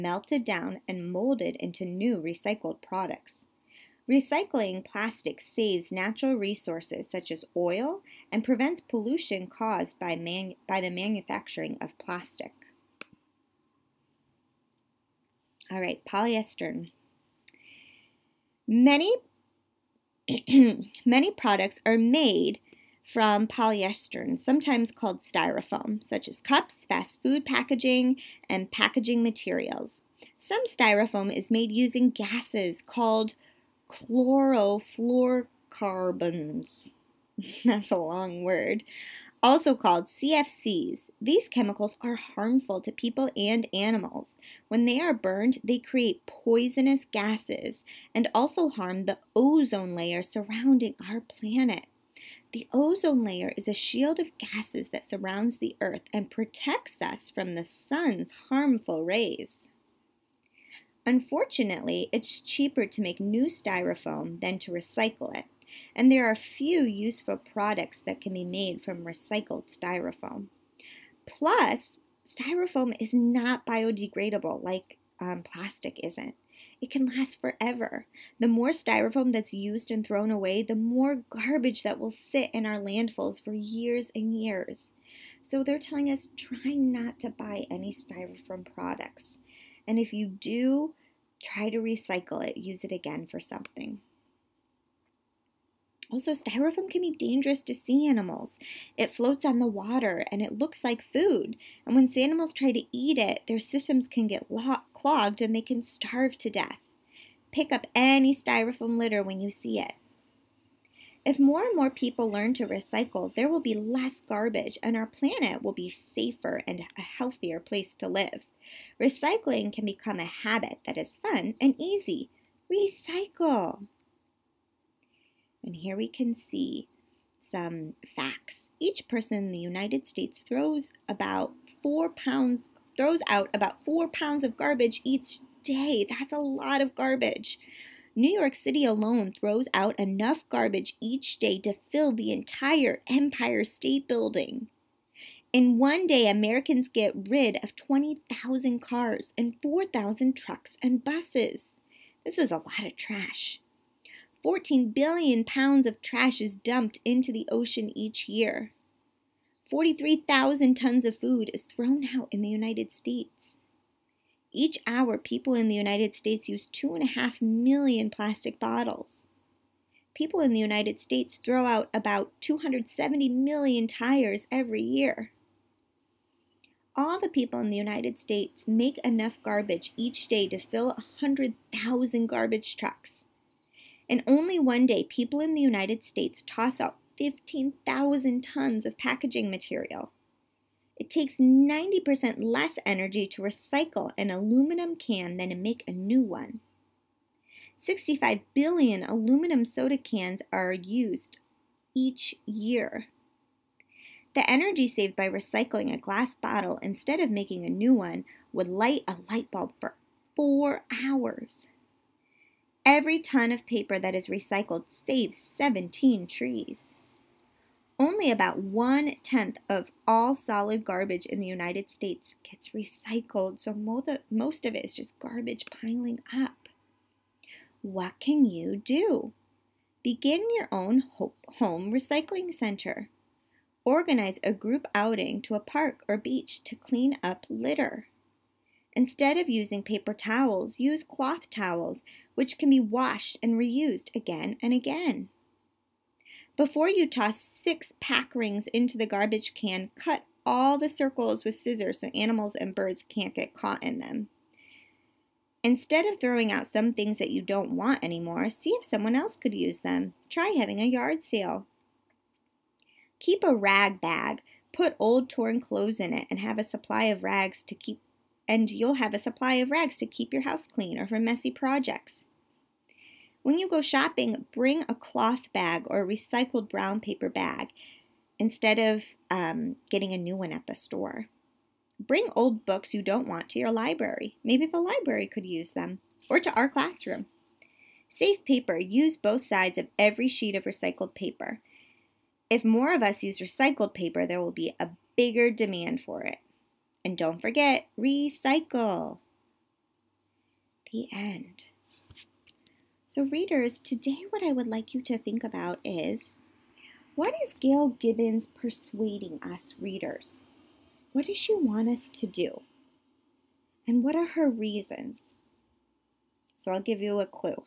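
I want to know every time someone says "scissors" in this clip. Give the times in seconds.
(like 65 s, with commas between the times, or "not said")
251 s.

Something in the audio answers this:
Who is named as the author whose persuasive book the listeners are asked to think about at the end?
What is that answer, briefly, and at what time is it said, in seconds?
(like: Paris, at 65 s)
Gail Gibbons, at 307 s.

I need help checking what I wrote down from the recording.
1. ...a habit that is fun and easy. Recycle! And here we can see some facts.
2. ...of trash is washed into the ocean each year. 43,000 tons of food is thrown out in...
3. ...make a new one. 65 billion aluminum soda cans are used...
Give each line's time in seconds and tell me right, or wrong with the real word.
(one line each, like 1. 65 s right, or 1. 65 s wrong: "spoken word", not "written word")
1. 120 s right
2. 155 s wrong: "dumped", not "washed"
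3. 195 s right.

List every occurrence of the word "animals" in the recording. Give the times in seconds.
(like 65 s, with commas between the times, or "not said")
43 s, 98 s, 102 s, 252 s.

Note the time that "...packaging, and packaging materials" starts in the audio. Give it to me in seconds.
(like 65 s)
27 s.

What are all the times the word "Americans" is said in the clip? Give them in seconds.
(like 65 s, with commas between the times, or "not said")
146 s.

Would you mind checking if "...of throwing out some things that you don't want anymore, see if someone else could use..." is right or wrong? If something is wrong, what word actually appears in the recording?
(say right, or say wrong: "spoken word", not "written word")
right.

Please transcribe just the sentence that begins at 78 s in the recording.
The more styrofoam that's used and thrown away, the more garbage that will sit in our landfills for years and years.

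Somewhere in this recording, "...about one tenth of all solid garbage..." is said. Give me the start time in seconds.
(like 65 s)
218 s.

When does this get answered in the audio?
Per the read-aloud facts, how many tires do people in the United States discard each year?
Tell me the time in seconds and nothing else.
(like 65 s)
172 s.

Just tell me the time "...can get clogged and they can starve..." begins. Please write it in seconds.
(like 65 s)
104 s.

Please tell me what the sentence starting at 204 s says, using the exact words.
The energy saved by recycling a glass bottle instead of making a new one would light a light bulb for four hours.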